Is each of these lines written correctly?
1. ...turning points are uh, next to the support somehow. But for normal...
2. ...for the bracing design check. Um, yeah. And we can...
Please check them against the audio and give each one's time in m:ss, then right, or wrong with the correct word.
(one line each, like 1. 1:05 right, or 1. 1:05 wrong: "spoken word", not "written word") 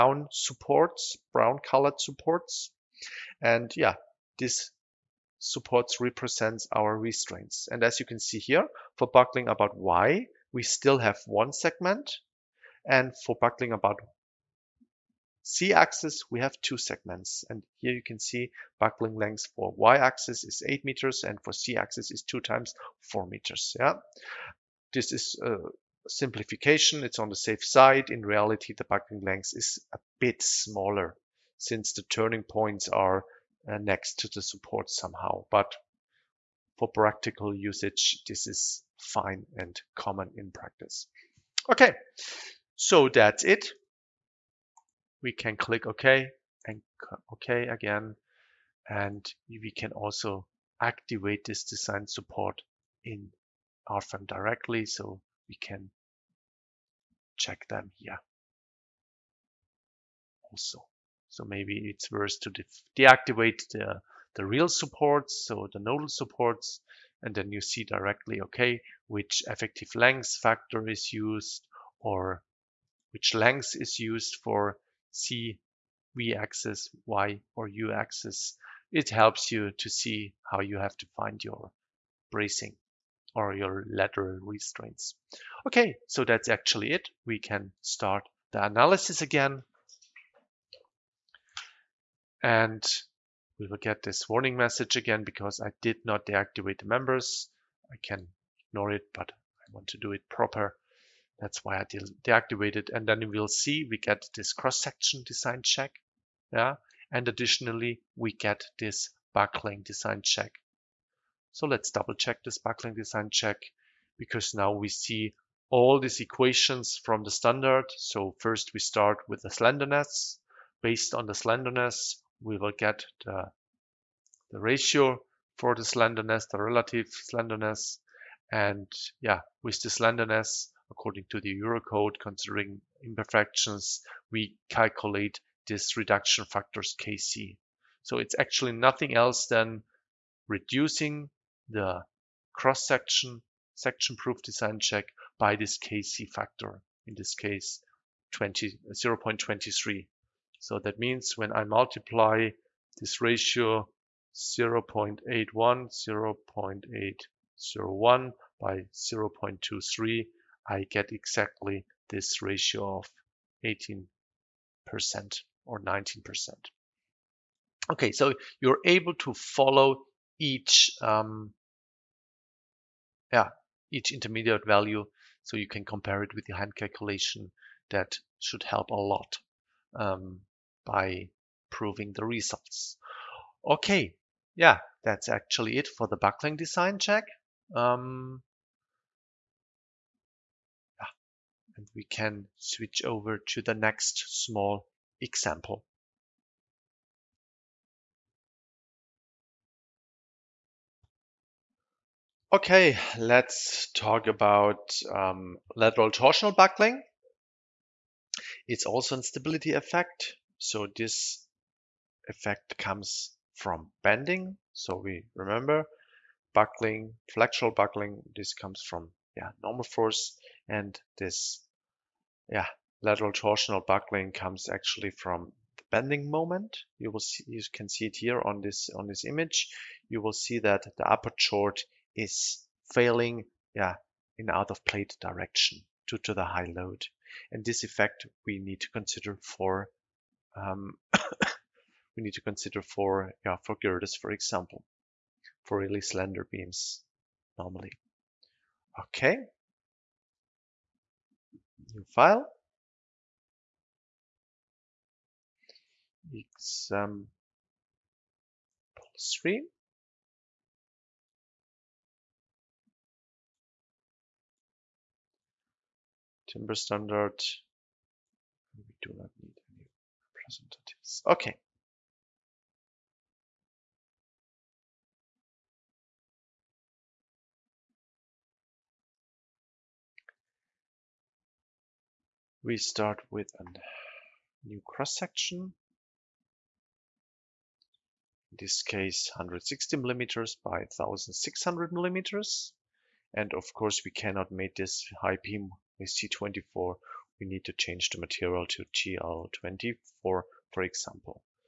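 1. 0:32 wrong: "practical", not "normal"
2. 3:05 wrong: "buckling", not "bracing".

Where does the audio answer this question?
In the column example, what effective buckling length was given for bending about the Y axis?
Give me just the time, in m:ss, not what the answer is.
0:20.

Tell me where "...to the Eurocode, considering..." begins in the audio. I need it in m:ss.
2:11.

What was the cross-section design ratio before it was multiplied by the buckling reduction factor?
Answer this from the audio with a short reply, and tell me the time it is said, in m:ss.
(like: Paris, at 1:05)
0.801, at 2:35.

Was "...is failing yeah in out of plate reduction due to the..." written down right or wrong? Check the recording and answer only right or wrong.
wrong.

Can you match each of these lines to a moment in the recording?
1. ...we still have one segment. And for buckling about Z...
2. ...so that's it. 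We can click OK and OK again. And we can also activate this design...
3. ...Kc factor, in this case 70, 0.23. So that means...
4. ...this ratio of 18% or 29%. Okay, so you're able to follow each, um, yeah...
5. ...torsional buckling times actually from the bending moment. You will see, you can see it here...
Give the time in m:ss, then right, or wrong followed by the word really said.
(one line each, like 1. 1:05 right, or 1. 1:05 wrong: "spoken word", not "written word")
1. 0:10 right
2. 0:42 right
3. 2:25 wrong: "20", not "70"
4. 2:42 wrong: "19", not "29"
5. 3:43 wrong: "comes", not "times".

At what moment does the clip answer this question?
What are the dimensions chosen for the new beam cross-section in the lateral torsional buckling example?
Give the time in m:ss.
4:49.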